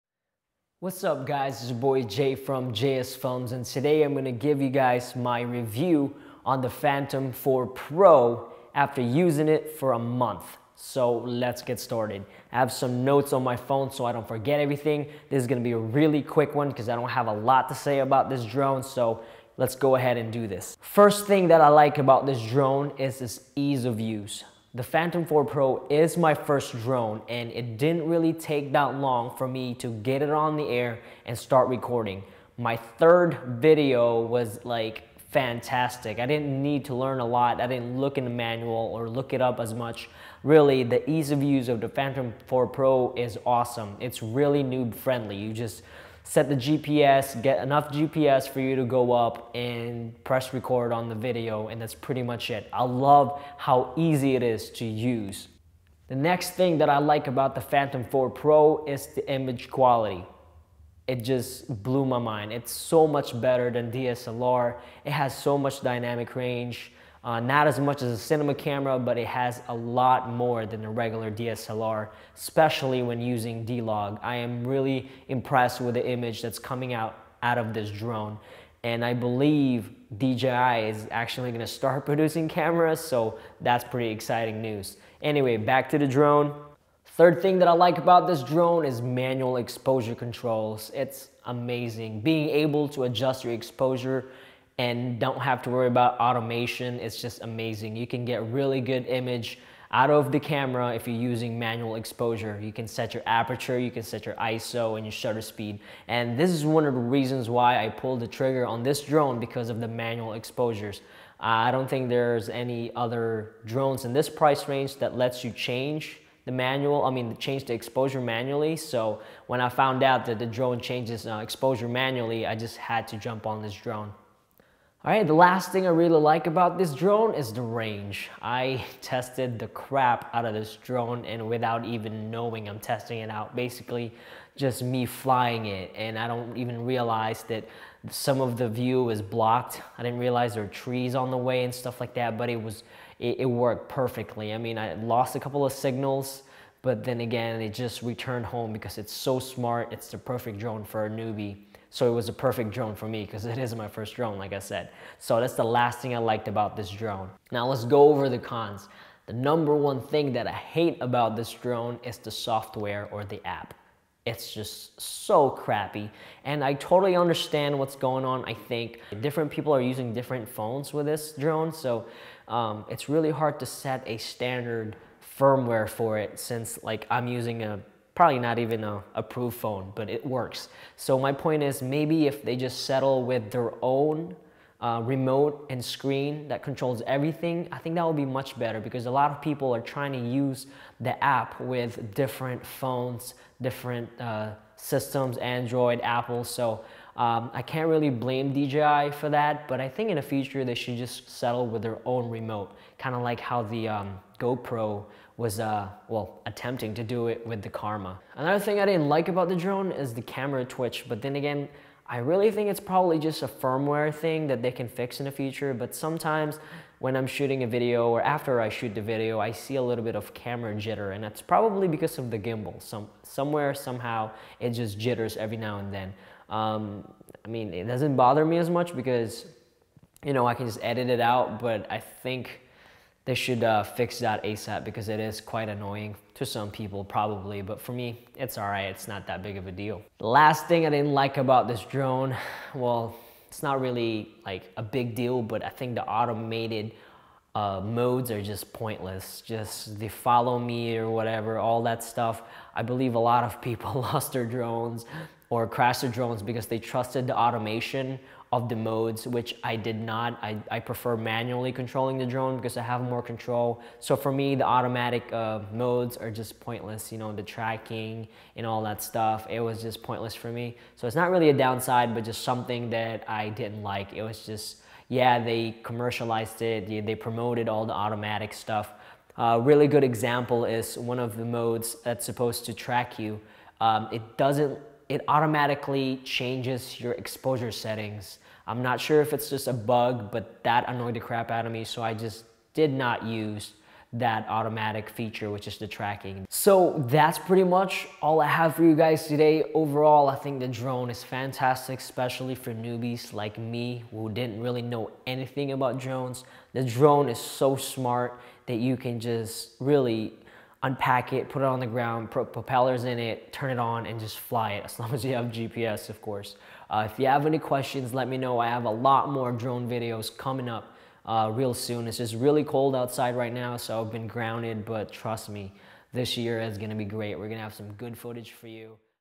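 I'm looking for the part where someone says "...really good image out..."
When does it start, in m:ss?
1:38.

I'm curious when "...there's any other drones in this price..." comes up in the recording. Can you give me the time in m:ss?
1:52.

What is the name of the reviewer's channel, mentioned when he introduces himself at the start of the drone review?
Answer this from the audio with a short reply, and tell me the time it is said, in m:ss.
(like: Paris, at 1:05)
JSFILMZ, at 0:02.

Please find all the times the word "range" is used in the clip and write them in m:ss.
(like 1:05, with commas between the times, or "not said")
1:06, 1:54, 2:07.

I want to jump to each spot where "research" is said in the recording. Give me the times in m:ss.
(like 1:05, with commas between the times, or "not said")
not said.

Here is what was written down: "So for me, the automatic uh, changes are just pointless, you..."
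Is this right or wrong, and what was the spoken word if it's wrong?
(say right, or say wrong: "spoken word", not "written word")
wrong: "modes", not "changes".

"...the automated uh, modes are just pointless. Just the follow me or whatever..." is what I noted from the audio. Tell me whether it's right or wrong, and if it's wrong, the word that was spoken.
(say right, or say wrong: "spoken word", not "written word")
right.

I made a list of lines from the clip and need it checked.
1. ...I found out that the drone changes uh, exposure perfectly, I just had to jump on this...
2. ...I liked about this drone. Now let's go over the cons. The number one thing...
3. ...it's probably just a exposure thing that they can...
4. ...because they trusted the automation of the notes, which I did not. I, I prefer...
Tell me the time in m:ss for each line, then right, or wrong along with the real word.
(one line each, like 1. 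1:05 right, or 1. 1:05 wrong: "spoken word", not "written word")
1. 1:59 wrong: "manually", not "perfectly"
2. 2:36 right
3. 3:32 wrong: "firmware", not "exposure"
4. 4:16 wrong: "modes", not "notes".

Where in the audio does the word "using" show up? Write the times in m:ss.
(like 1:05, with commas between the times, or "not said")
0:08, 1:13, 1:41, 2:49, 2:57.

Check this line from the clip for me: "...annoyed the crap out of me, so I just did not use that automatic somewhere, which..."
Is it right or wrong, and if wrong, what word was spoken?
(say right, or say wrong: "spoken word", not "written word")
wrong: "feature", not "somewhere".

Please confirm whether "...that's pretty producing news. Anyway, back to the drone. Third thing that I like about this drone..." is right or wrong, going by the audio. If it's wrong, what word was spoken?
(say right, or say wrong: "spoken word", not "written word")
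wrong: "exciting", not "producing".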